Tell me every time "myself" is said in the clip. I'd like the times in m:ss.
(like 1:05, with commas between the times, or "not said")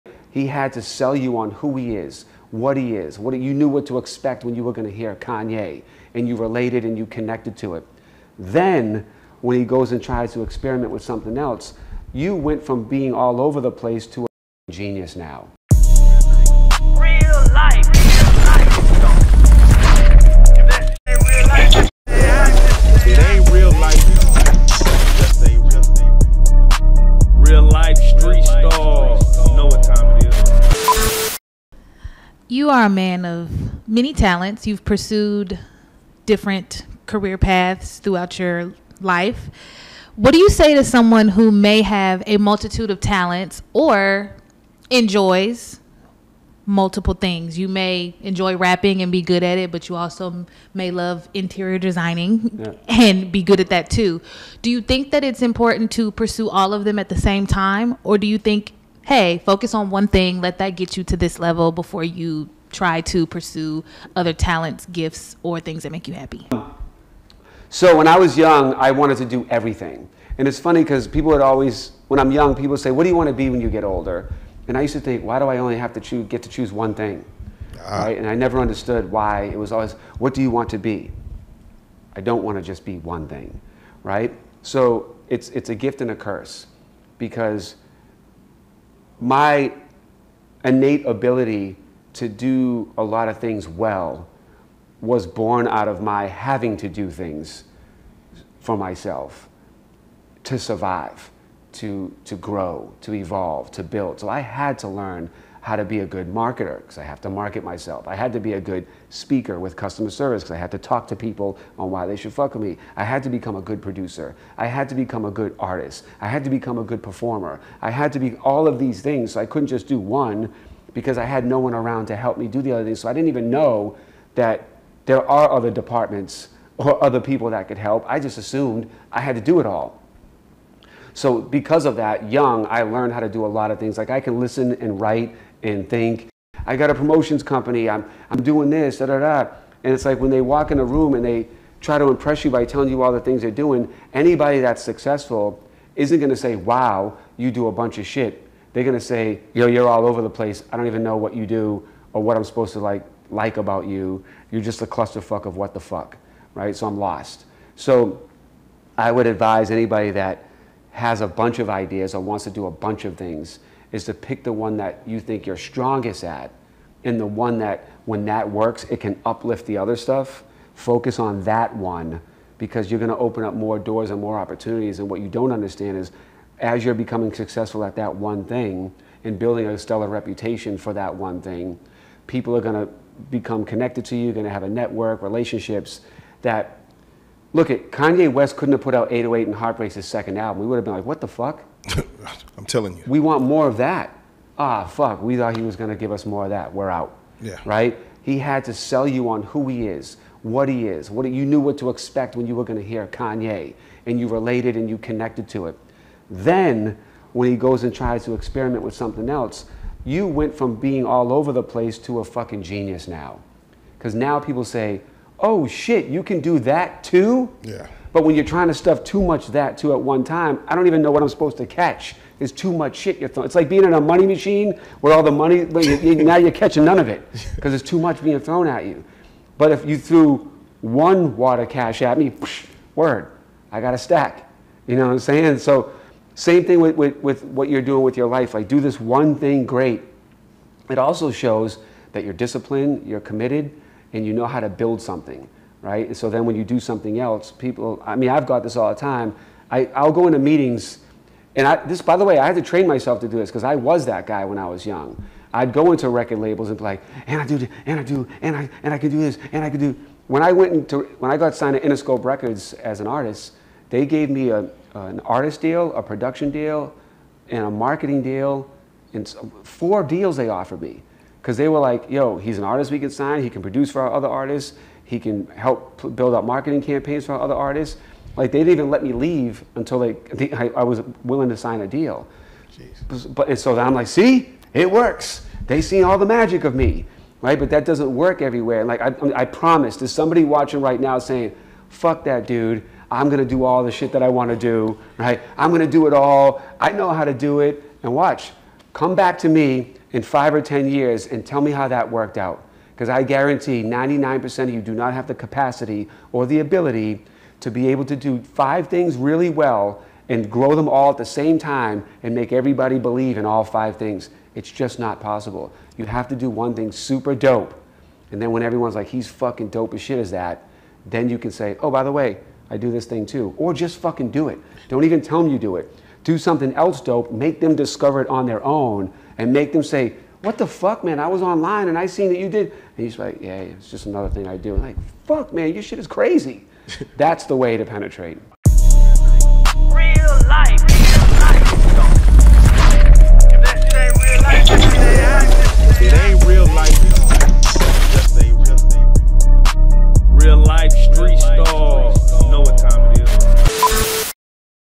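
1:38, 1:47, 4:12.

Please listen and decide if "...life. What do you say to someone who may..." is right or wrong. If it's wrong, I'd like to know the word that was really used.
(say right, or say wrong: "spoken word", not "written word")
right.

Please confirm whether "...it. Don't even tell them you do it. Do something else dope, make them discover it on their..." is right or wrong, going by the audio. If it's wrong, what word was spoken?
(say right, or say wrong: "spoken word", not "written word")
right.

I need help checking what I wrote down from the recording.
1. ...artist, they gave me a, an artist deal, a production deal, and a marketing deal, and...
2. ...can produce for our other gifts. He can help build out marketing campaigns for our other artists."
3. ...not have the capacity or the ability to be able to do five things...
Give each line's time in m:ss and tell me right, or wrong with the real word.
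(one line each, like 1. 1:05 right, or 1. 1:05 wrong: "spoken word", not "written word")
1. 4:23 right
2. 4:33 wrong: "artists", not "gifts"
3. 5:04 right.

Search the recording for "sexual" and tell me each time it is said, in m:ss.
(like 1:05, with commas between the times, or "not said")
not said.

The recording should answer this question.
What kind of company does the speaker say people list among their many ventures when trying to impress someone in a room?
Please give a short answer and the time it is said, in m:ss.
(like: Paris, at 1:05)
Promotions company, at 2:16.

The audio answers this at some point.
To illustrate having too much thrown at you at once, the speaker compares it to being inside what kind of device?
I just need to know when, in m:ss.
3:44.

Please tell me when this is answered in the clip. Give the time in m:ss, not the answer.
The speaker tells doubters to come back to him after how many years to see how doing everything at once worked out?
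5:00.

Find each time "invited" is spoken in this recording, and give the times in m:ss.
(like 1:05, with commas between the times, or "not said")
not said.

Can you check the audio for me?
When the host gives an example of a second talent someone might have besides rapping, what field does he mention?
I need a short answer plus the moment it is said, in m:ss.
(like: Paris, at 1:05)
Interior designing, at 0:51.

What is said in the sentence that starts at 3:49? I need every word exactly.
But if you threw one wad of cash at me, word, I got a stack.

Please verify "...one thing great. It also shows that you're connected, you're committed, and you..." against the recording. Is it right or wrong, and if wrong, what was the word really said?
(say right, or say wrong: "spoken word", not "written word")
wrong: "disciplined", not "connected".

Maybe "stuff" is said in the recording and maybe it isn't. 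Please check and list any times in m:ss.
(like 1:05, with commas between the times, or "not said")
2:49, 3:38.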